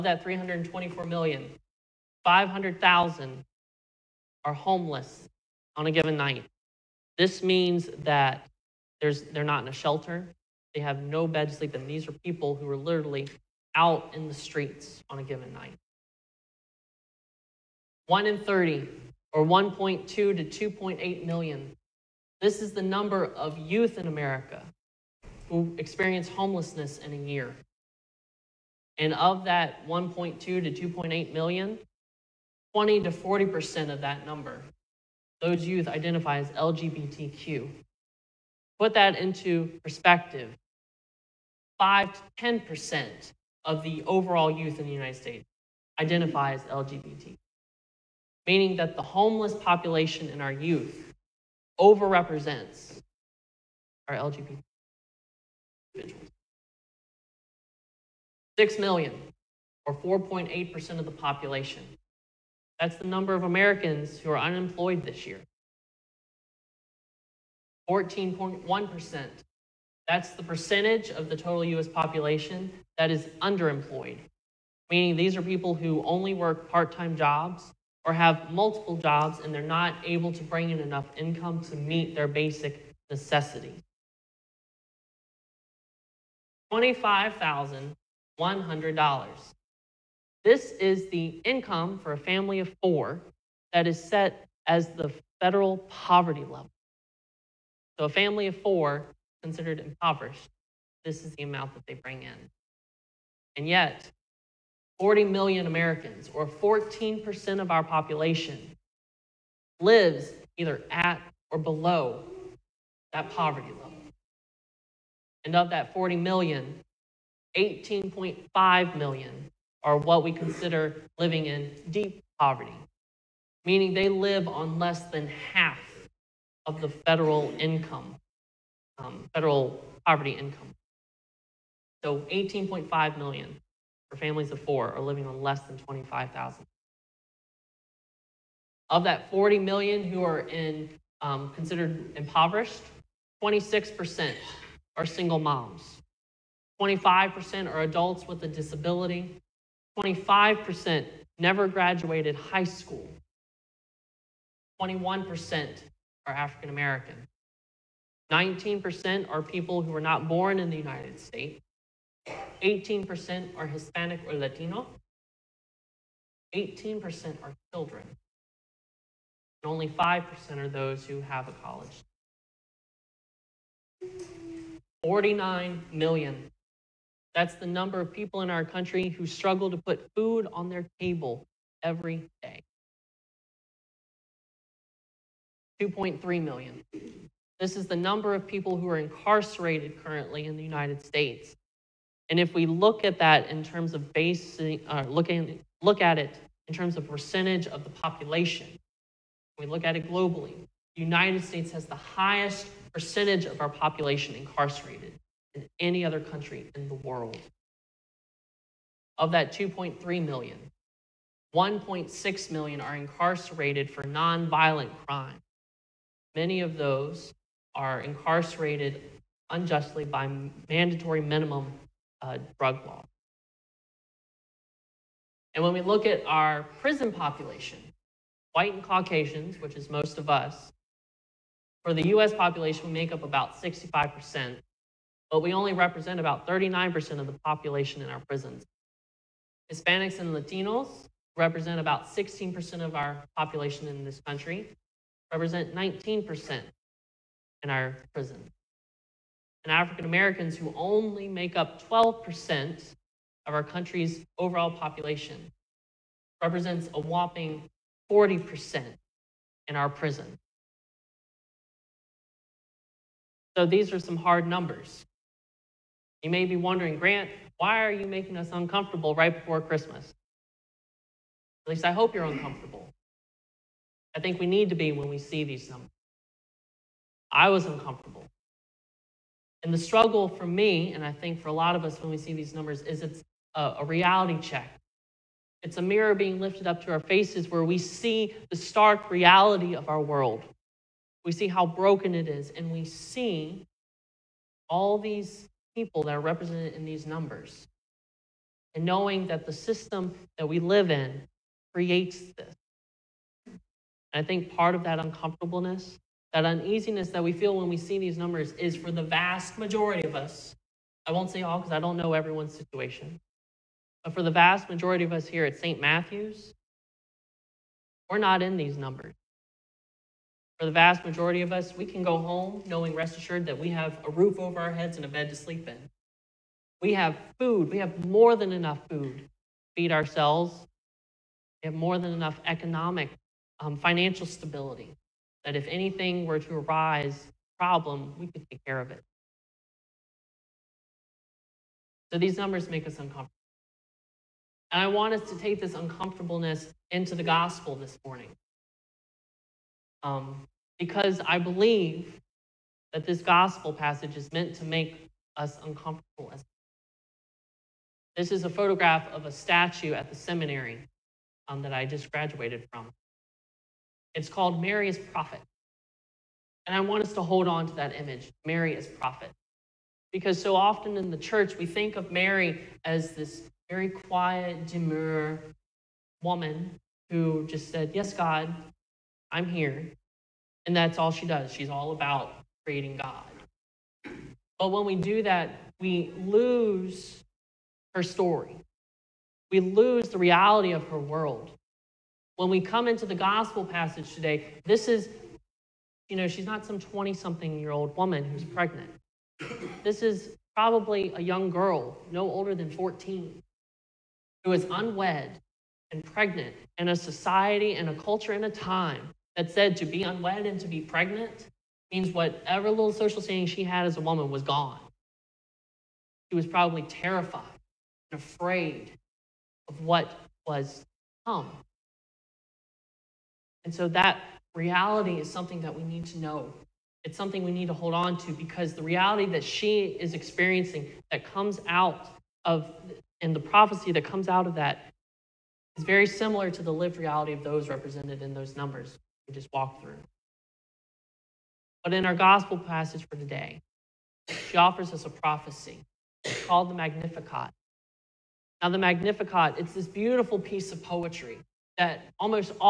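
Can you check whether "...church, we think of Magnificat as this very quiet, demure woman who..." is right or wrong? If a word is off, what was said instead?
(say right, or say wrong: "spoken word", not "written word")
wrong: "Mary", not "Magnificat".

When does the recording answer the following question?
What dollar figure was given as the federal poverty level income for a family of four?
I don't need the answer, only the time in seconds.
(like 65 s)
86 s.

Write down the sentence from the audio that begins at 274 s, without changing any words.
I think we need to be when we see these numbers.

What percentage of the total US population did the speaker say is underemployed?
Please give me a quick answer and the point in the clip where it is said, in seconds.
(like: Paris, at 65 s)
14.1%, at 67 s.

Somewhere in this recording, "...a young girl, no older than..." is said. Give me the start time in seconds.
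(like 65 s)
401 s.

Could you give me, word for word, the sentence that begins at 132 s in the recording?
So 18.5 million for families of four are living on less than 25,000.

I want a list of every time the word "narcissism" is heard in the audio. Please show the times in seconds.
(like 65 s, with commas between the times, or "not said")
not said.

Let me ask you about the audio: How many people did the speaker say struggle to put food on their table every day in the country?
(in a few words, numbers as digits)
49 million.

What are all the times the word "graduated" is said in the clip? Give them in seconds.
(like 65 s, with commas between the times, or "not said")
151 s, 362 s.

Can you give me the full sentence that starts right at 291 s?
We see how broken it is, and we see all these people that are represented in these numbers.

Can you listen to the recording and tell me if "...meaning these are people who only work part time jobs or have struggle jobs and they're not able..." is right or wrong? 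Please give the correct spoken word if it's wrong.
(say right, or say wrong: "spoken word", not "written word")
wrong: "multiple", not "struggle".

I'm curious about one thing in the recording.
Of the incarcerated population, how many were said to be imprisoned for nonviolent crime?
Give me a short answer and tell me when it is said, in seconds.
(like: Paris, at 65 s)
1.6 million, at 211 s.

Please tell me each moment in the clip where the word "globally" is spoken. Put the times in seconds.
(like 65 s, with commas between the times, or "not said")
200 s.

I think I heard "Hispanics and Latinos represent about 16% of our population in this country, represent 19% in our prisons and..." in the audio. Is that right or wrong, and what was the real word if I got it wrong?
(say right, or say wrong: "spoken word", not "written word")
right.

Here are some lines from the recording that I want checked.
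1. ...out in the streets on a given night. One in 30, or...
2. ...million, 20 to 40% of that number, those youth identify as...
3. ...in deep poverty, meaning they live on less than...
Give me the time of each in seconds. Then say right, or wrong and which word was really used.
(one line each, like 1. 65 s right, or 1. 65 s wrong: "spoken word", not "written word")
1. 13 s right
2. 31 s right
3. 121 s right.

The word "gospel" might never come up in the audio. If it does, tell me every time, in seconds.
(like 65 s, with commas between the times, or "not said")
347 s, 353 s, 393 s, 442 s.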